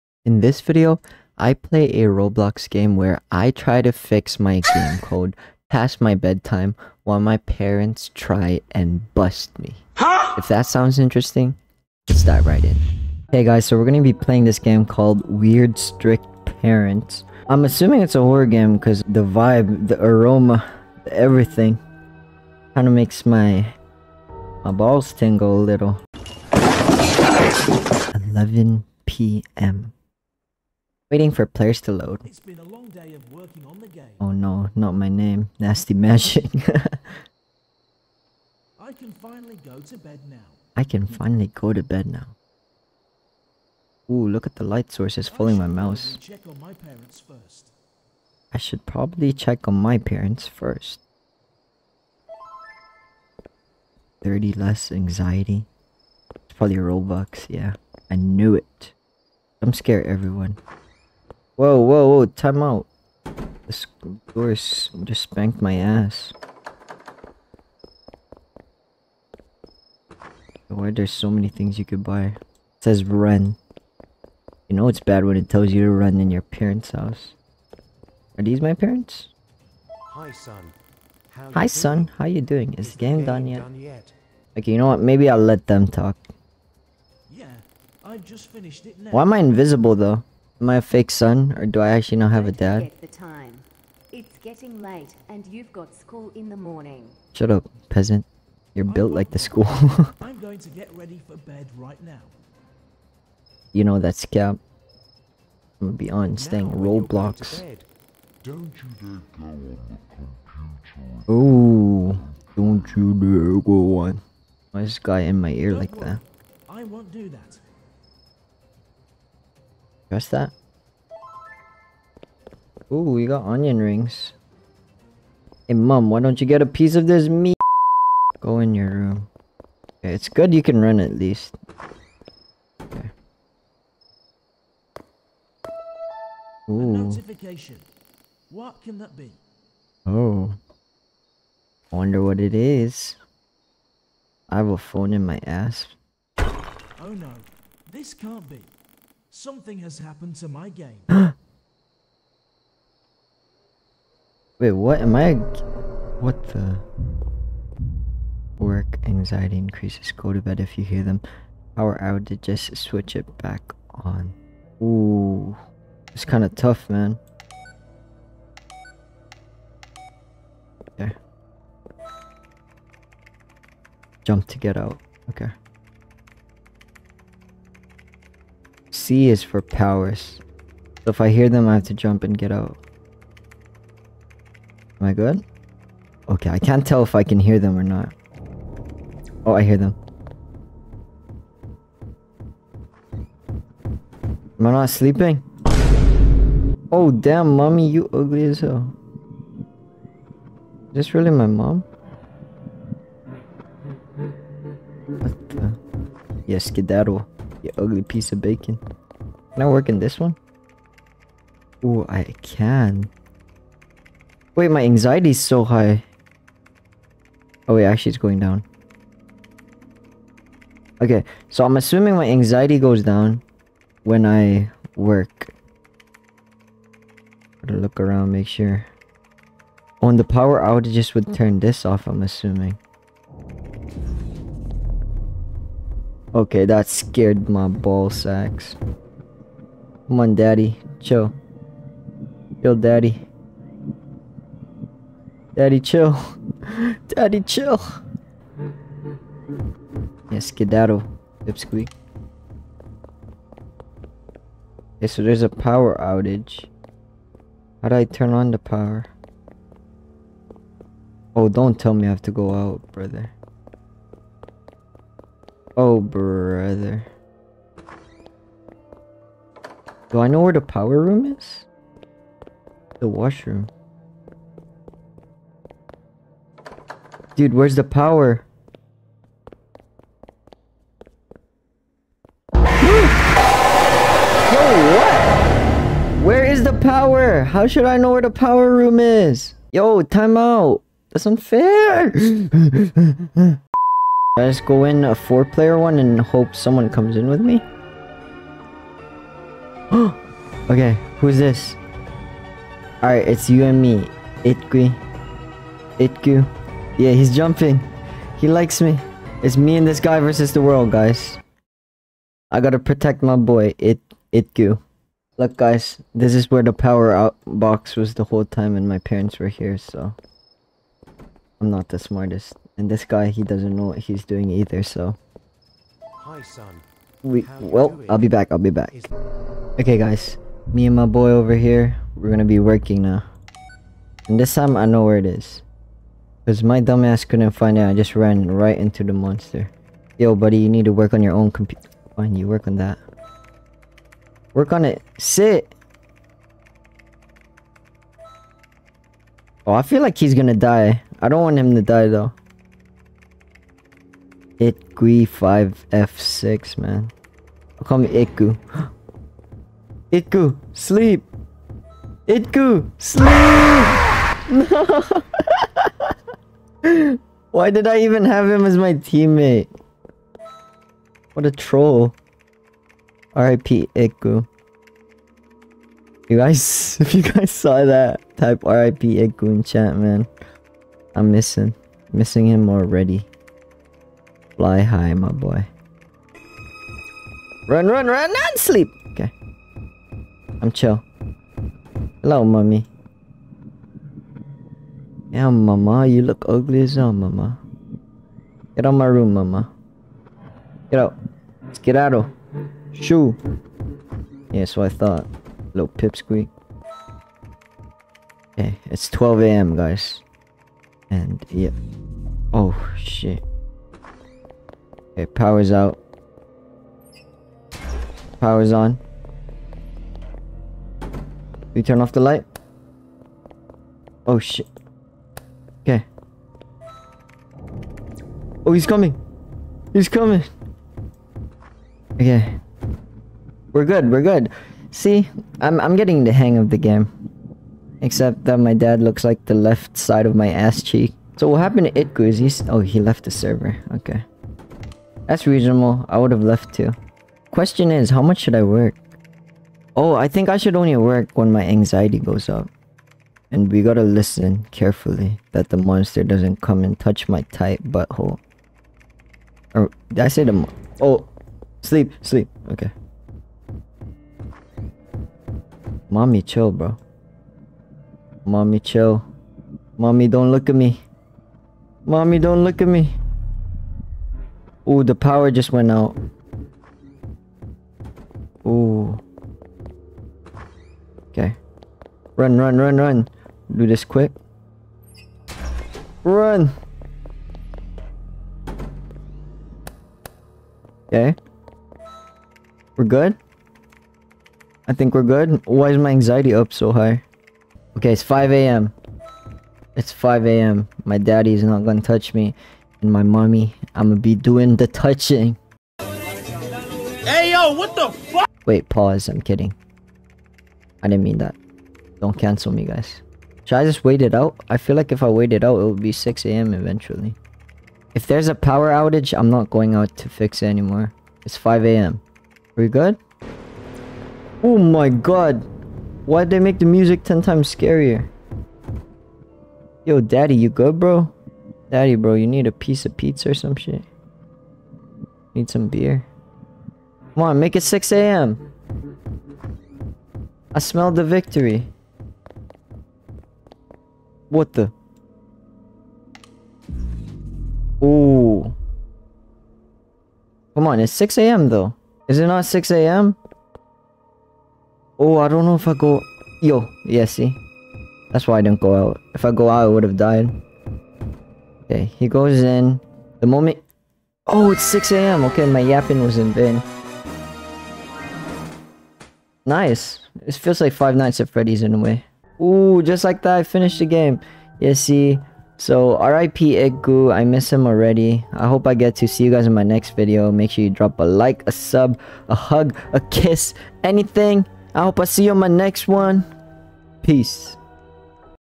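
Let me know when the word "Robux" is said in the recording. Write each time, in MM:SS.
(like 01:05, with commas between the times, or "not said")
00:56.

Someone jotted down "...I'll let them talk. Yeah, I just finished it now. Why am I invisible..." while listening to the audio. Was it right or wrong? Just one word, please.
right.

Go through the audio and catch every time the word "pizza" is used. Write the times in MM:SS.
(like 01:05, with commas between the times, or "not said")
08:53.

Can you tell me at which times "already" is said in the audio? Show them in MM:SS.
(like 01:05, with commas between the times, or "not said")
06:22, 09:37.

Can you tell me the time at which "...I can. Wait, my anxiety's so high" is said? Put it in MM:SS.
03:32.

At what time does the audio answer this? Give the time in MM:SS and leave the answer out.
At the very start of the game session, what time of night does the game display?
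00:28.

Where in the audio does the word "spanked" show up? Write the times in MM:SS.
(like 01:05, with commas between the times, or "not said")
01:05.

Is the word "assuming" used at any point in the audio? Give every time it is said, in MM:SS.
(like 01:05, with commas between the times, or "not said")
00:17, 03:41, 03:52.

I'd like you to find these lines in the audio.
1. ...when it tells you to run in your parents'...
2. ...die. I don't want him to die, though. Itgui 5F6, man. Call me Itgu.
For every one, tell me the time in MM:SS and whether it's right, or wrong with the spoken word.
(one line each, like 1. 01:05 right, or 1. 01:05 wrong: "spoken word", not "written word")
1. 01:15 right
2. 05:50 right.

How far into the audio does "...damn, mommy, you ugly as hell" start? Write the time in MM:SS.
03:17.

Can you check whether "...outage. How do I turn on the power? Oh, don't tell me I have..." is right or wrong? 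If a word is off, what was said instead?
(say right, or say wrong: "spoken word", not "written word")
right.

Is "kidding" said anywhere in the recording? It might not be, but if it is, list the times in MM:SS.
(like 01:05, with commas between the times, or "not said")
08:29.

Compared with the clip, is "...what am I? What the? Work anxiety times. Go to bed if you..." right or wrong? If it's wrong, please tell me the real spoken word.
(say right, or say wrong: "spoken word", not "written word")
wrong: "increases", not "times".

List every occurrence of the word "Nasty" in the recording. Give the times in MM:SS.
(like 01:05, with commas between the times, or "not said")
00:35.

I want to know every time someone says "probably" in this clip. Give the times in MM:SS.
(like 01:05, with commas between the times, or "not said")
00:48, 00:56.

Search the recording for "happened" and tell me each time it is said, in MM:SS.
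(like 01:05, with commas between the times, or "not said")
02:29, 07:21.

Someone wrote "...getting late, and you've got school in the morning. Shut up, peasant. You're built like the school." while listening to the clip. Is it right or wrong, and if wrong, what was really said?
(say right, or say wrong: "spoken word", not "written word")
right.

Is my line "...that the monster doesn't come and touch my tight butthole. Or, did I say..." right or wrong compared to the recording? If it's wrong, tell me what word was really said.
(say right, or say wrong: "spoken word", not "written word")
right.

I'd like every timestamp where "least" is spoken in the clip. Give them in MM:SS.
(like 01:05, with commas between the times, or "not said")
02:11.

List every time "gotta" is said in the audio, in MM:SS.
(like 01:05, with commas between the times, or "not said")
03:47, 05:12, 07:33.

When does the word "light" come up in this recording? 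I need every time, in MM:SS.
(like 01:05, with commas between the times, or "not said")
00:44, 07:02.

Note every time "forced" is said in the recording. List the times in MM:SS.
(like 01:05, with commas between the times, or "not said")
not said.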